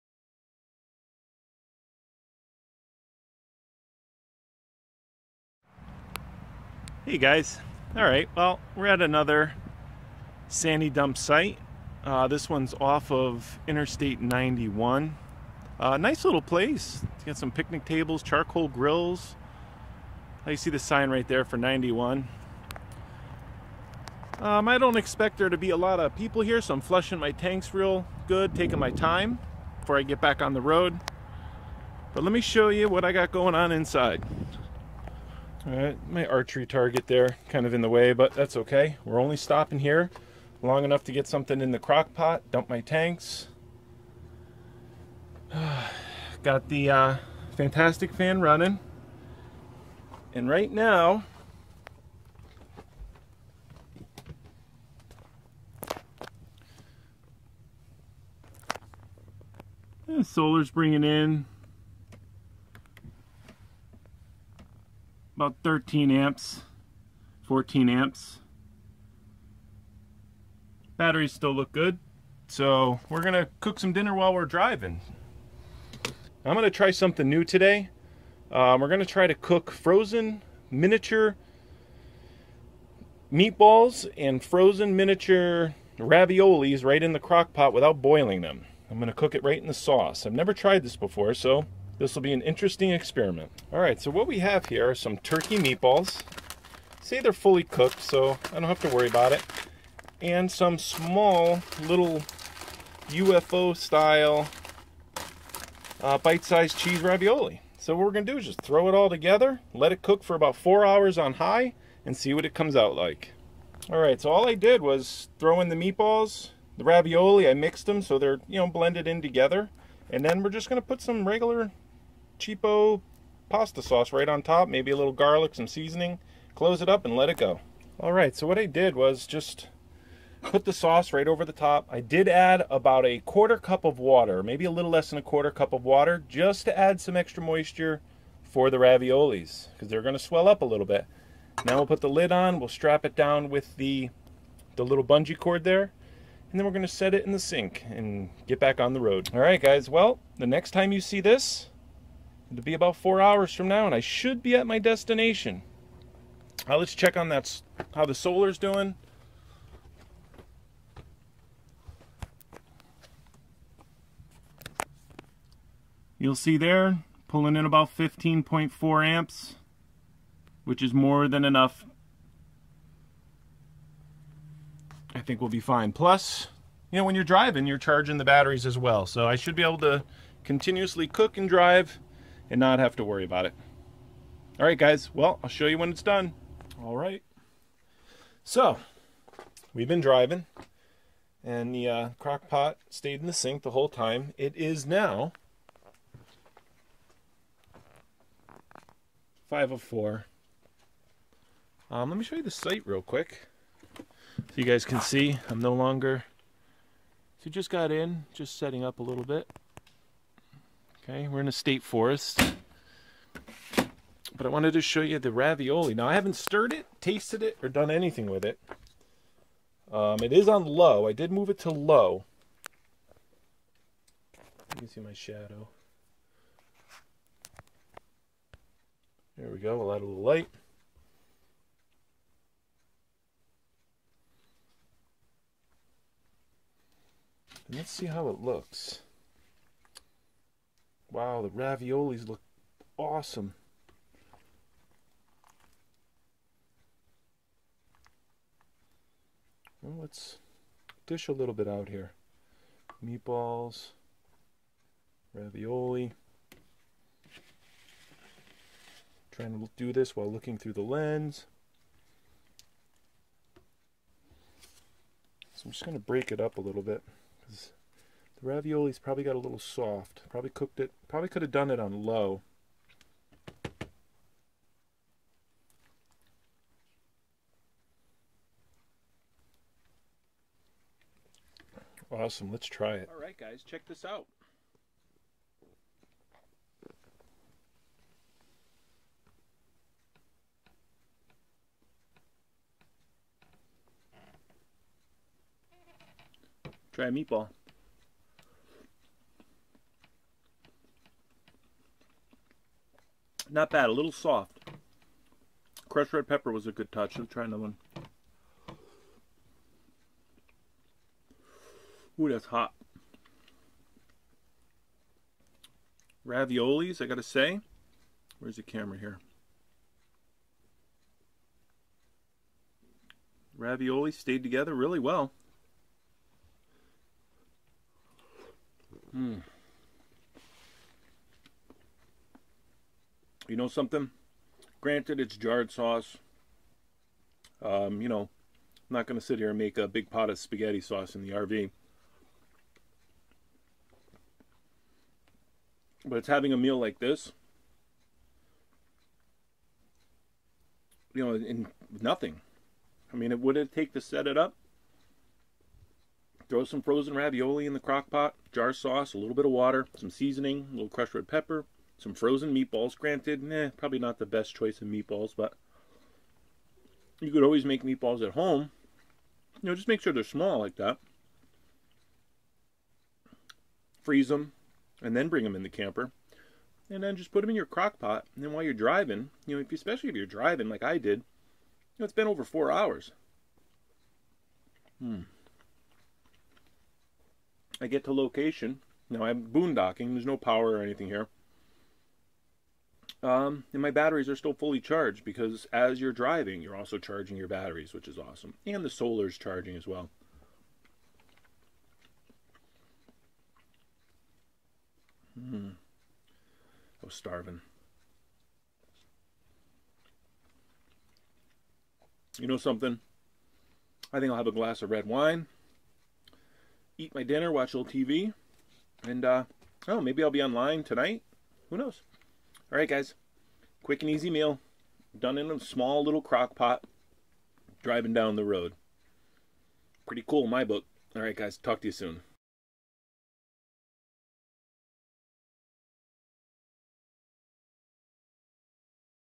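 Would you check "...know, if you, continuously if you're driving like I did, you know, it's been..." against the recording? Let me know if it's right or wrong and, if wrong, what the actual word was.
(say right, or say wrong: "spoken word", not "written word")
wrong: "especially", not "continuously".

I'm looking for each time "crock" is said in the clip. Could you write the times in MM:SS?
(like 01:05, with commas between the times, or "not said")
00:41, 01:27, 03:12, 05:57, 06:17, 07:06.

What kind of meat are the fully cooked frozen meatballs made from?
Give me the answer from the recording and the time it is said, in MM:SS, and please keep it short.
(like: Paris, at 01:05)
turkey, at 01:35.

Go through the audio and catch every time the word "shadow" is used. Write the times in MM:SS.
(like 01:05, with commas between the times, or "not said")
03:45.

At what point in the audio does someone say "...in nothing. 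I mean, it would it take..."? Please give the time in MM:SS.
05:51.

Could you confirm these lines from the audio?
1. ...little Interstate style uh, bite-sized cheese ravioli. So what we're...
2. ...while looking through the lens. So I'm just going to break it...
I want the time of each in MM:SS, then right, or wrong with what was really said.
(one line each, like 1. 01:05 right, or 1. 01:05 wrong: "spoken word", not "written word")
1. 01:41 wrong: "UFO", not "Interstate"
2. 04:20 right.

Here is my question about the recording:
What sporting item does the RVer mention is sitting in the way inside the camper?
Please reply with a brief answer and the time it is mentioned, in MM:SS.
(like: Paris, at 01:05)
archery target, at 00:36.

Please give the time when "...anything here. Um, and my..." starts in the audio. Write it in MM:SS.
06:30.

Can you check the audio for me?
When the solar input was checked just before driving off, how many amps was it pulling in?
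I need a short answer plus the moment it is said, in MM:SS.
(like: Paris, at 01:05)
15.4 amps, at 02:47.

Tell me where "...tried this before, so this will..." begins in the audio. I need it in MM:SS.
01:30.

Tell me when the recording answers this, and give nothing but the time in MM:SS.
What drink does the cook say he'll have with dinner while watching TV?
06:54.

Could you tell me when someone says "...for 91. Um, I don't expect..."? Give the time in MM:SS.
00:21.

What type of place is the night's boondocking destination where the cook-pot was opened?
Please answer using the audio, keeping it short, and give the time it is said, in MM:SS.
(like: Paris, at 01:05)
state forest, at 03:31.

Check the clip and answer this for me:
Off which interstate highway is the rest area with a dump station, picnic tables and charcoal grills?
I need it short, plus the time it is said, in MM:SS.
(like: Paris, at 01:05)
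Interstate 91, at 00:13.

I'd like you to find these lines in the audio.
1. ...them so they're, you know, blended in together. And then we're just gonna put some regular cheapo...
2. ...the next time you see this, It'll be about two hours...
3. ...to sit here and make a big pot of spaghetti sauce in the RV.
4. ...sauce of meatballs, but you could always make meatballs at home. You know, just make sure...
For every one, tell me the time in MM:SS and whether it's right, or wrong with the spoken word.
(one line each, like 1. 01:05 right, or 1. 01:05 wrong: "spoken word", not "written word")
1. 01:57 right
2. 02:30 wrong: "four", not "two"
3. 05:39 right
4. 06:04 wrong: "choice", not "sauce".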